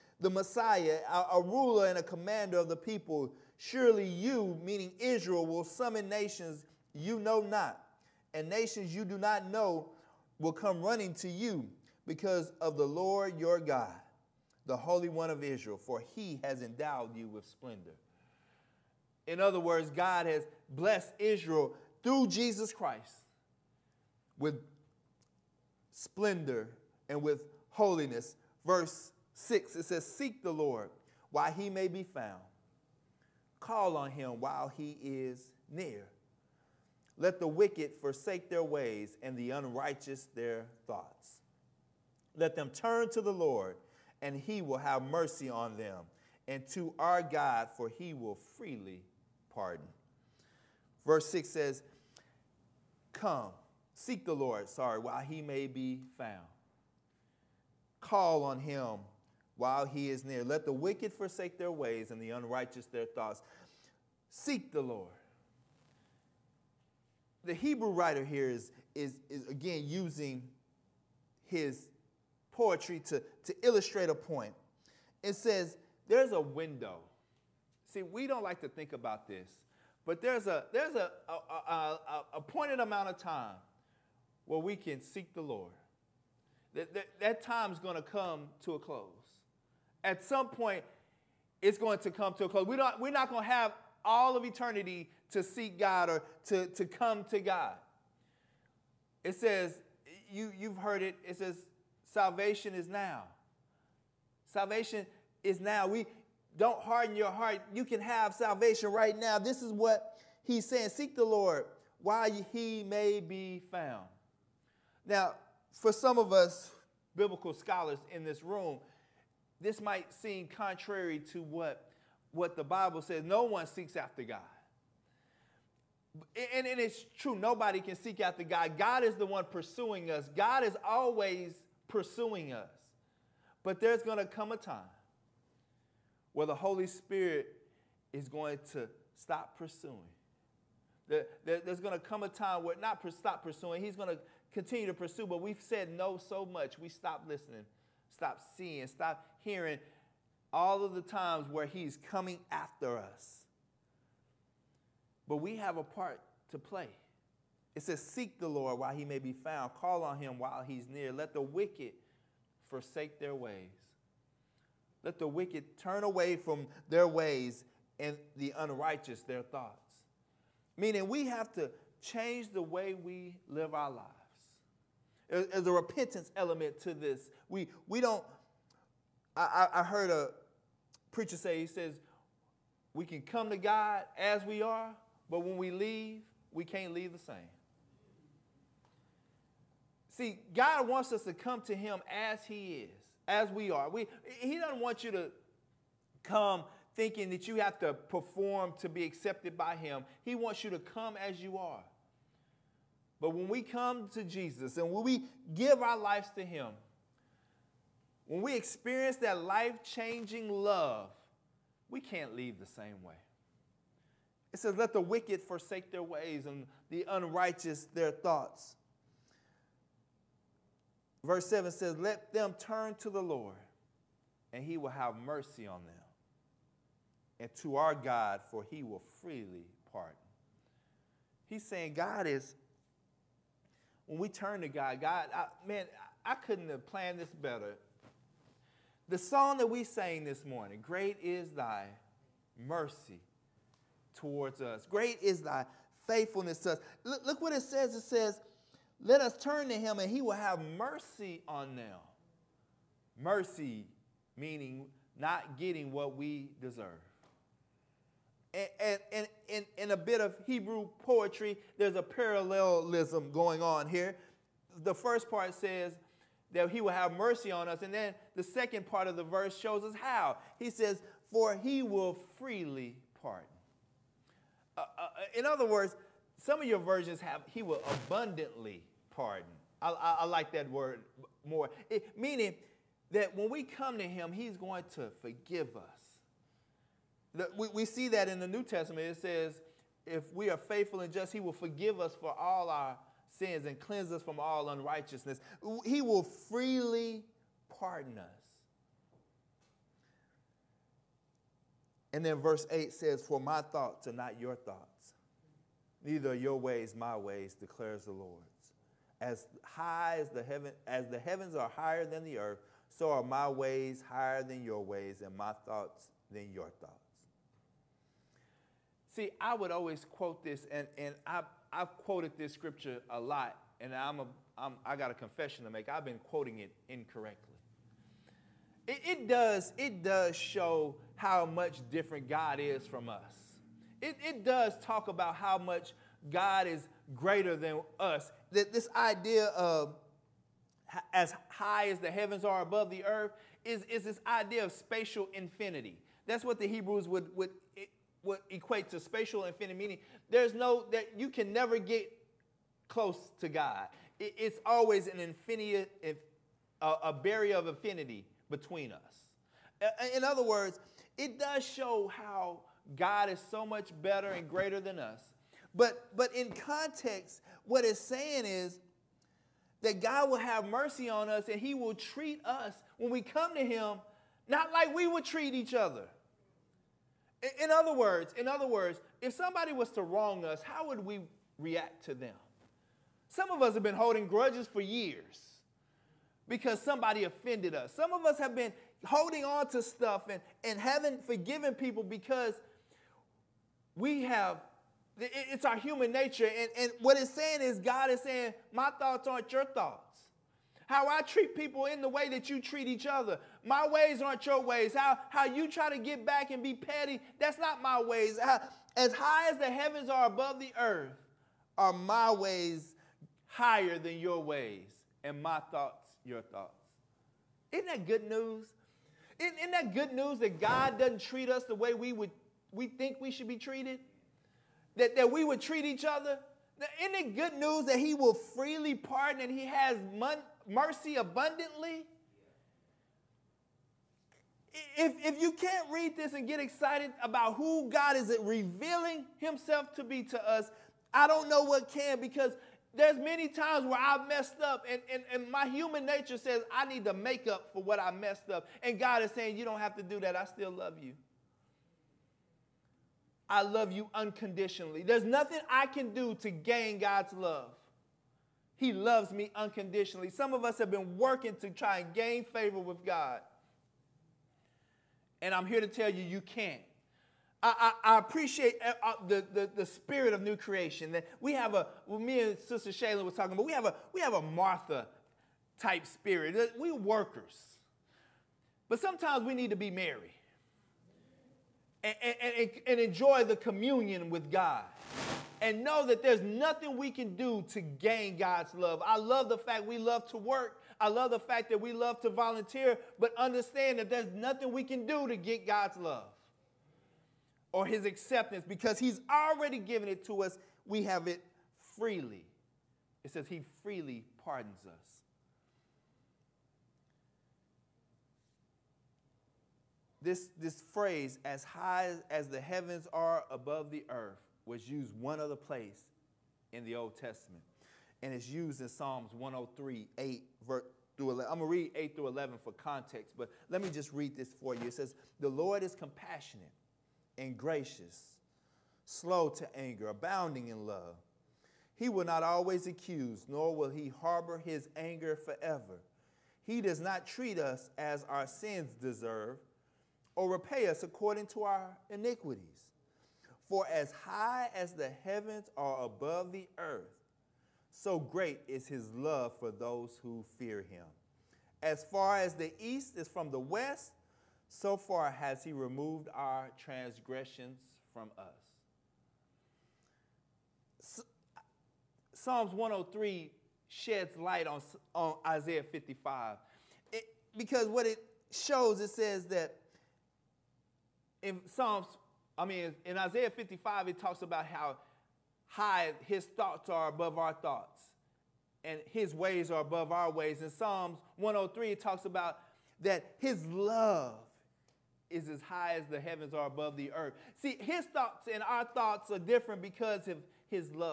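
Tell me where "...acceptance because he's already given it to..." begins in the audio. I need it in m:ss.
8:18.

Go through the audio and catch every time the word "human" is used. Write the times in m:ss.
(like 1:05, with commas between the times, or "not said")
6:35, 7:25.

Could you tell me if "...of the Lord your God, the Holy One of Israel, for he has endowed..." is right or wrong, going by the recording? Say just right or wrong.
right.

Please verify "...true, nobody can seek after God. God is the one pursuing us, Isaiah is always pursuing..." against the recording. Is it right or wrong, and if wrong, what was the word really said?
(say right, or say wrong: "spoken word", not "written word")
wrong: "God", not "Isaiah".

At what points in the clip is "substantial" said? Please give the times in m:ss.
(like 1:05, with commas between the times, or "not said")
not said.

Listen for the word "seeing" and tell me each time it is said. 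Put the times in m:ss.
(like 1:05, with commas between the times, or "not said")
2:28.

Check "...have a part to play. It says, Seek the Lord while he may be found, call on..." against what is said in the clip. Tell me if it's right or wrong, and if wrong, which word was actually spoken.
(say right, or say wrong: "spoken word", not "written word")
right.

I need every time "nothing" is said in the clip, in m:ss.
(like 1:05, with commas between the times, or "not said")
7:35, 8:06, 8:14.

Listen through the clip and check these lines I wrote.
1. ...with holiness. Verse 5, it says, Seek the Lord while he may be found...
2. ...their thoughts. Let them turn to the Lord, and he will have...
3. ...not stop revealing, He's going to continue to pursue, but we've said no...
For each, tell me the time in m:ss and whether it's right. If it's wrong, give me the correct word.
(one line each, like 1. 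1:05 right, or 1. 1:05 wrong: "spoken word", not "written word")
1. 0:27 wrong: "6", not "5"
2. 0:40 right
3. 2:22 wrong: "pursuing", not "revealing".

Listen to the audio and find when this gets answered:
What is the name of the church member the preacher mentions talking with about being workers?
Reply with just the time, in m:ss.
7:52.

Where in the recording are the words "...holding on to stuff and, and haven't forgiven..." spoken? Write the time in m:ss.
6:29.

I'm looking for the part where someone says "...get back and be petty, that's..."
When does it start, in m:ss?
6:45.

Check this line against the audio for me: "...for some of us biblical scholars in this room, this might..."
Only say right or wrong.
right.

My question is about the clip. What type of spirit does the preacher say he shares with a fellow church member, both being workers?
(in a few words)
Martha type spirit.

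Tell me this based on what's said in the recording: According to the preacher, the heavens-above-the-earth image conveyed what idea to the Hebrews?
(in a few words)
spatial infinity.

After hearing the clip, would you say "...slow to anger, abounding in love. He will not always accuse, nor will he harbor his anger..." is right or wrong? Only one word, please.
right.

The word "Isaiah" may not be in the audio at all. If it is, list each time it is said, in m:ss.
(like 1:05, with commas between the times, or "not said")
9:25, 9:33.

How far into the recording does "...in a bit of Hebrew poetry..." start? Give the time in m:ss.
4:19.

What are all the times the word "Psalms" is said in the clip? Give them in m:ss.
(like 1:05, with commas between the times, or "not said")
8:38, 9:22, 9:31, 9:40.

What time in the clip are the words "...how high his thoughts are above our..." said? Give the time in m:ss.
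9:34.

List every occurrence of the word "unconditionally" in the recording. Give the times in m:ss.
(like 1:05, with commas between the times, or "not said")
7:34, 7:39.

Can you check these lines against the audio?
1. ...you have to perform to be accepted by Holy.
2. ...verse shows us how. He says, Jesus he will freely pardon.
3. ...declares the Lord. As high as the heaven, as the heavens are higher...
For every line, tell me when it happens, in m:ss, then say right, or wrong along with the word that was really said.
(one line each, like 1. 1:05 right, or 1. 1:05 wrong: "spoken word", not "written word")
1. 3:17 wrong: "Him", not "Holy"
2. 4:29 wrong: "For", not "Jesus"
3. 5:07 right.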